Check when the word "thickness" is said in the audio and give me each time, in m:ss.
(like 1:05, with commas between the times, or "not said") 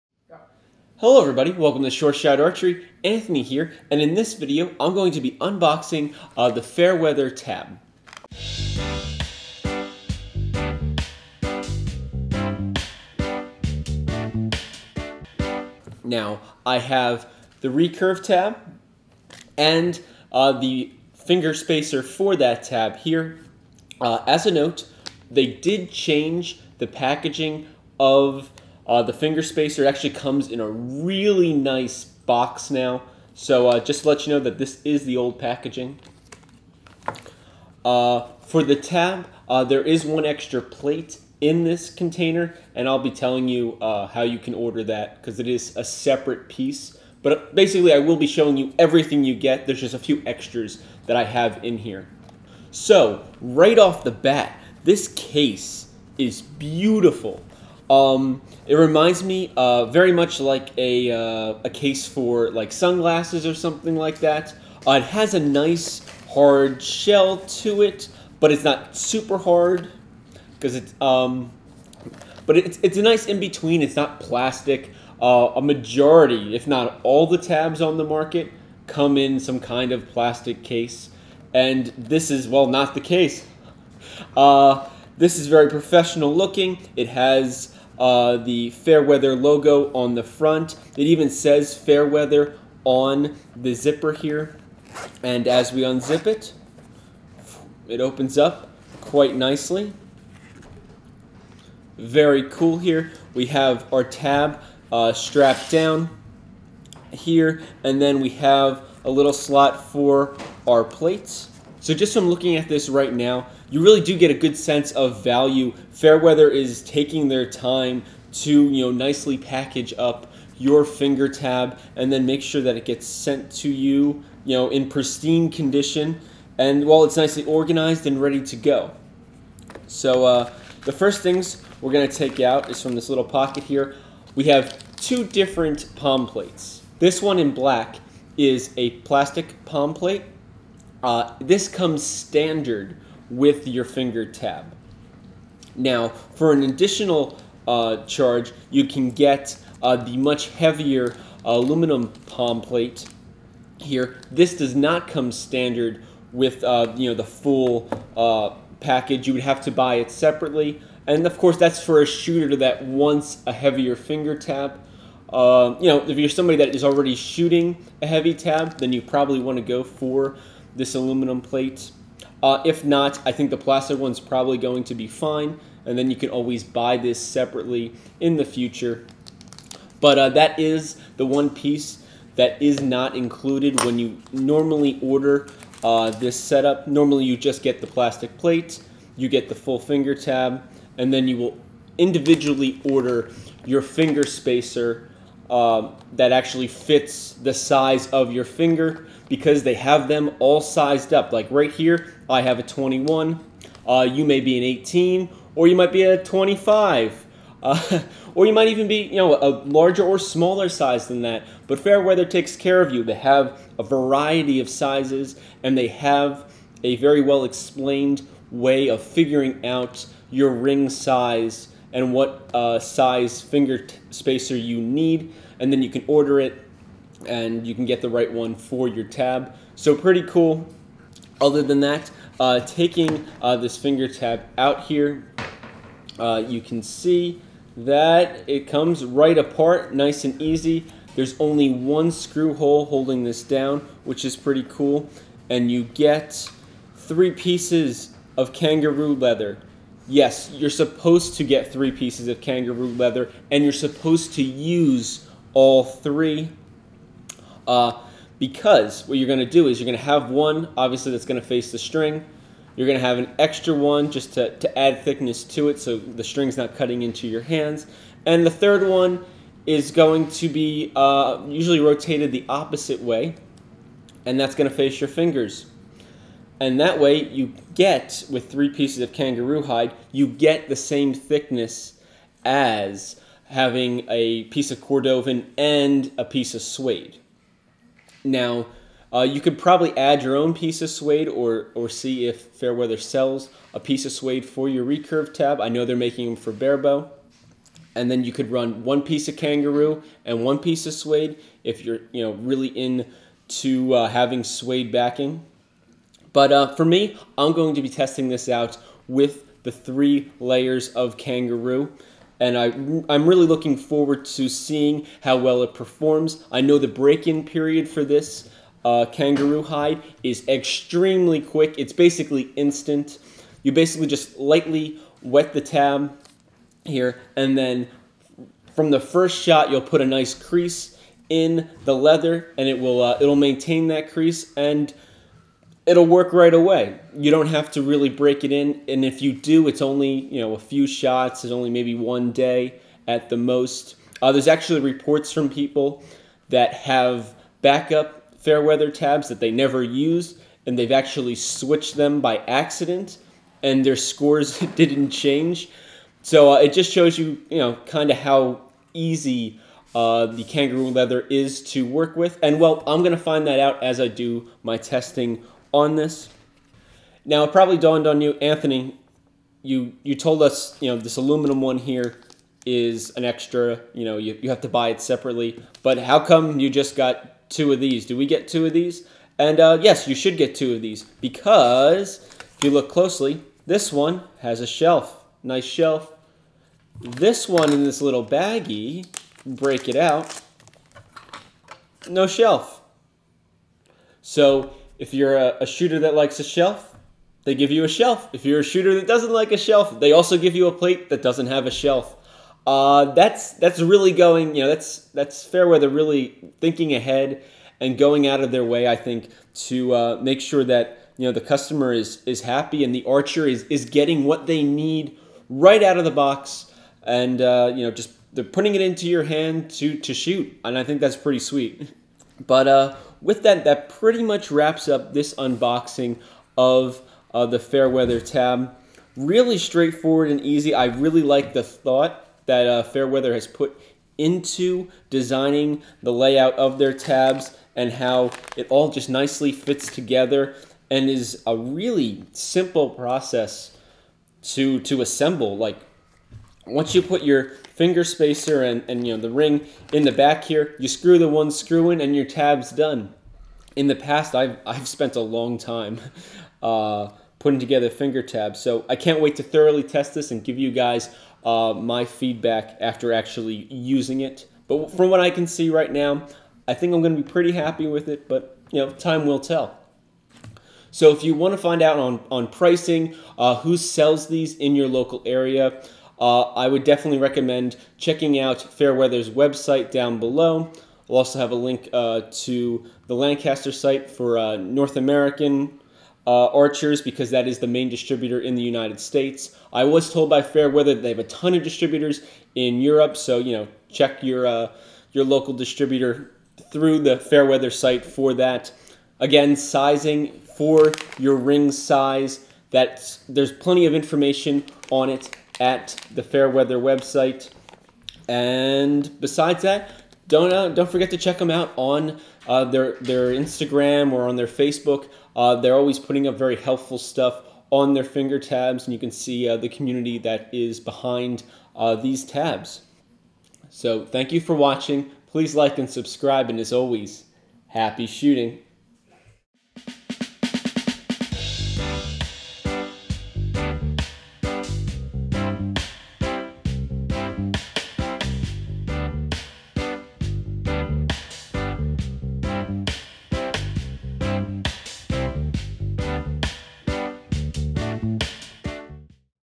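4:25, 4:41.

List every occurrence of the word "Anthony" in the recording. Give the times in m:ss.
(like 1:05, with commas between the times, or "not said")
0:03, 6:08.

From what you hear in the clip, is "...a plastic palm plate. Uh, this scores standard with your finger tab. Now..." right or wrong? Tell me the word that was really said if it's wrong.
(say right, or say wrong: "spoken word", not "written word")
wrong: "comes", not "scores".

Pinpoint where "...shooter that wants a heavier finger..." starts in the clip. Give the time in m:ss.
2:42.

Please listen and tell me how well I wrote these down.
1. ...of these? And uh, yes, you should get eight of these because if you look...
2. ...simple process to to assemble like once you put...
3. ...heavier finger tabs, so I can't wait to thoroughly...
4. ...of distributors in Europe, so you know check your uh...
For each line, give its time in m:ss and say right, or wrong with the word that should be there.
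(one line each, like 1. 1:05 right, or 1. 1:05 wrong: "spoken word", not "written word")
1. 6:18 wrong: "two", not "eight"
2. 7:22 right
3. 7:37 wrong: "together", not "heavier"
4. 8:11 right.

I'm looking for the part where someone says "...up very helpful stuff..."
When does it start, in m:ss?
8:36.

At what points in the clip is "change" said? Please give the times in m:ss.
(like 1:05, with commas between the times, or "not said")
0:25, 5:55.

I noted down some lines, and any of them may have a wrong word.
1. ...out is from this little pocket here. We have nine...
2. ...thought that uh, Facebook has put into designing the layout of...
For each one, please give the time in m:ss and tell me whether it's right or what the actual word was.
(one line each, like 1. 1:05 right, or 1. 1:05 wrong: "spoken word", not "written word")
1. 2:12 wrong: "two", not "nine"
2. 7:11 wrong: "Fairweather", not "Facebook".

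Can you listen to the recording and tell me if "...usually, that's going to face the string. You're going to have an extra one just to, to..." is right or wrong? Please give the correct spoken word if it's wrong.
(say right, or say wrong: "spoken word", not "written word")
wrong: "obviously", not "usually".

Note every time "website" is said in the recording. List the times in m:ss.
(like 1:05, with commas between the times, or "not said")
7:59, 8:26.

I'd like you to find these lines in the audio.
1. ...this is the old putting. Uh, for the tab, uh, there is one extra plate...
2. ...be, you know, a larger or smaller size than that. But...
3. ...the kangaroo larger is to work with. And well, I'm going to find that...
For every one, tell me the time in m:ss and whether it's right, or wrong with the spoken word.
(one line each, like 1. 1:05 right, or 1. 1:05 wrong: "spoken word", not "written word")
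1. 0:34 wrong: "packaging", not "putting"
2. 3:28 right
3. 6:00 wrong: "leather", not "larger".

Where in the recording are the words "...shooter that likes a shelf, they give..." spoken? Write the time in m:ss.
6:35.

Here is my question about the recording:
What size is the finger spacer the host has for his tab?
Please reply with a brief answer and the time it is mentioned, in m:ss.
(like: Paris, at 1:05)
21, at 3:22.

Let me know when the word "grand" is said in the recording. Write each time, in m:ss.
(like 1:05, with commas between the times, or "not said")
not said.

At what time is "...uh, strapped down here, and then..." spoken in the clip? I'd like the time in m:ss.
1:44.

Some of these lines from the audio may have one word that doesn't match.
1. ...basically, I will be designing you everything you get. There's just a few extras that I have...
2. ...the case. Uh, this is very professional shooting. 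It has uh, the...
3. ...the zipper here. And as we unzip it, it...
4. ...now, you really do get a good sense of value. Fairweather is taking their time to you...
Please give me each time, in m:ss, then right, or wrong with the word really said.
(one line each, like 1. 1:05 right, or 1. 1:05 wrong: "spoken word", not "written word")
1. 0:47 wrong: "showing", not "designing"
2. 1:22 wrong: "looking", not "shooting"
3. 1:33 right
4. 1:53 right.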